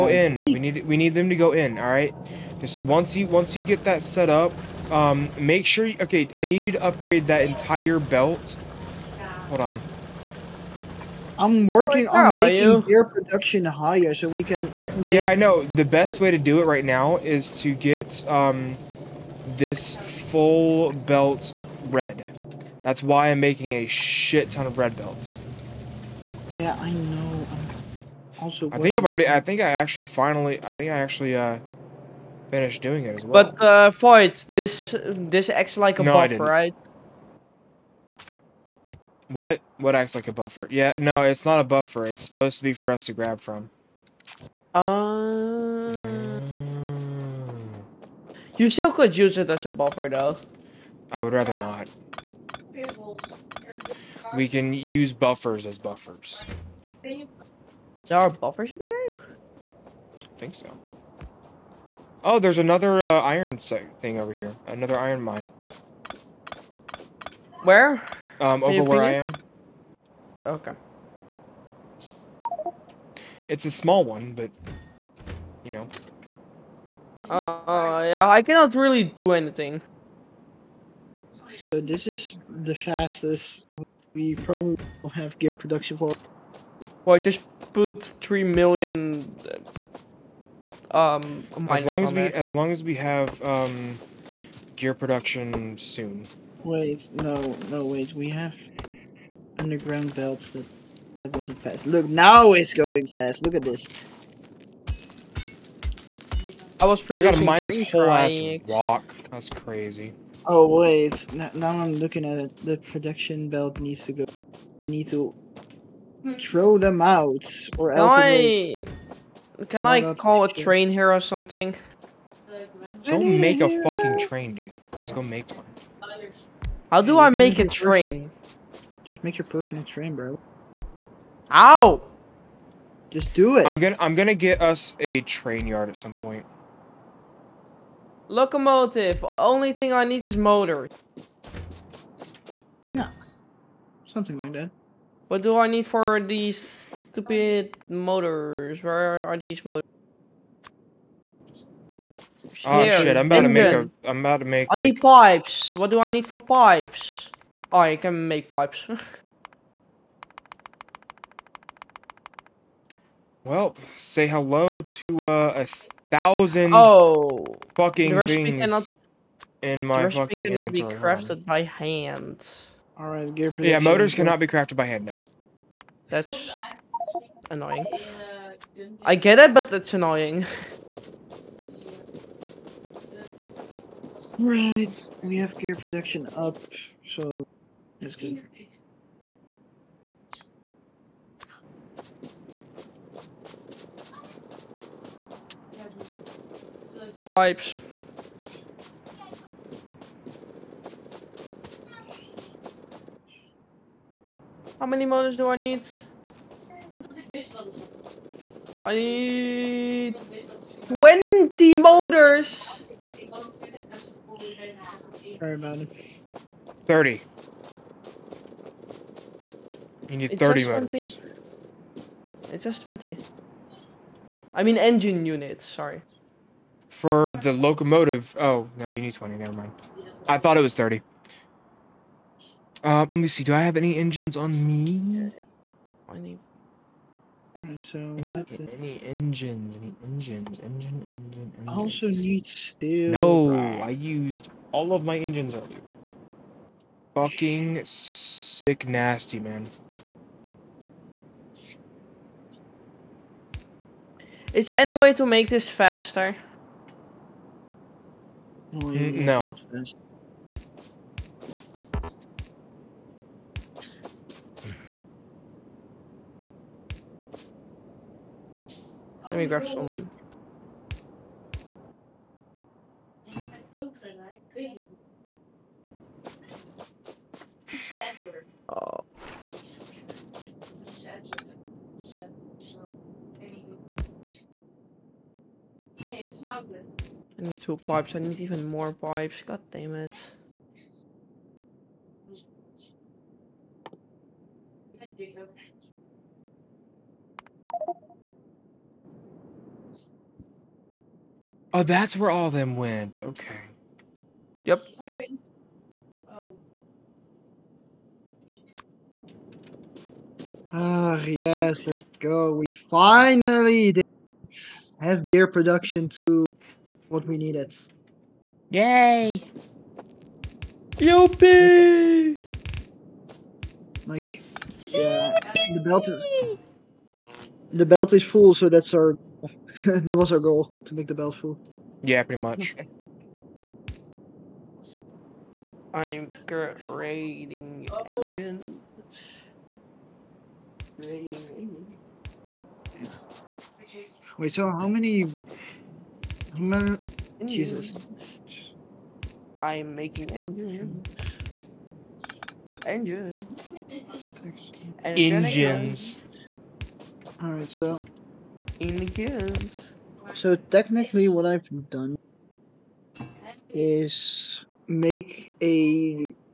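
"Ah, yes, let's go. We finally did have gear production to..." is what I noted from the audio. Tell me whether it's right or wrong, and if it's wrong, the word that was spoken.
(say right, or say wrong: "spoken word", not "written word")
right.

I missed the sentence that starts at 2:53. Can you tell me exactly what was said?
Motors cannot be crafted by hand now.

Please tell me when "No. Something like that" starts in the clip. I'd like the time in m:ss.
2:22.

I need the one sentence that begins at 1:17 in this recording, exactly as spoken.
Uh, yeah, I cannot really do anything.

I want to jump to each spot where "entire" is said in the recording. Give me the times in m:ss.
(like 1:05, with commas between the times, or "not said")
0:07.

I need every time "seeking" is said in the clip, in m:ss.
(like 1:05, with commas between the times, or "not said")
not said.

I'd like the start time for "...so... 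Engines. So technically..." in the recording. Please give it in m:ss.
5:57.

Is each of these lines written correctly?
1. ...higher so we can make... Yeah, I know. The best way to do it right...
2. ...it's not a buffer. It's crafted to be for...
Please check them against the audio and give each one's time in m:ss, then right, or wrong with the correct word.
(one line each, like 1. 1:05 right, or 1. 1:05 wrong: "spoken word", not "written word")
1. 0:13 right
2. 0:41 wrong: "supposed", not "crafted".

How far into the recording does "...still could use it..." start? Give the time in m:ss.
0:48.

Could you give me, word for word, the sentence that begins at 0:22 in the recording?
That's why I'm making a shit ton of red belts.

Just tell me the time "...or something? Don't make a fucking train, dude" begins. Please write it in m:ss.
2:01.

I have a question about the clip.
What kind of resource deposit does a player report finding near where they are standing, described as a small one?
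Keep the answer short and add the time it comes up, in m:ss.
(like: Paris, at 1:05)
Iron mine, at 1:04.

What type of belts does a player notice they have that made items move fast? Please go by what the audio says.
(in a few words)
Underground belts.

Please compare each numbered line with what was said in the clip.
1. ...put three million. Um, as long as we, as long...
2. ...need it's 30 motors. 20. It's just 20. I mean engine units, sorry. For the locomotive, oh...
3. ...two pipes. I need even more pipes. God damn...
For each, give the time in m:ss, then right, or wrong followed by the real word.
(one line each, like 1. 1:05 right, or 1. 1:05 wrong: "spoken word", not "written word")
1. 1:27 right
2. 3:40 right
3. 4:47 right.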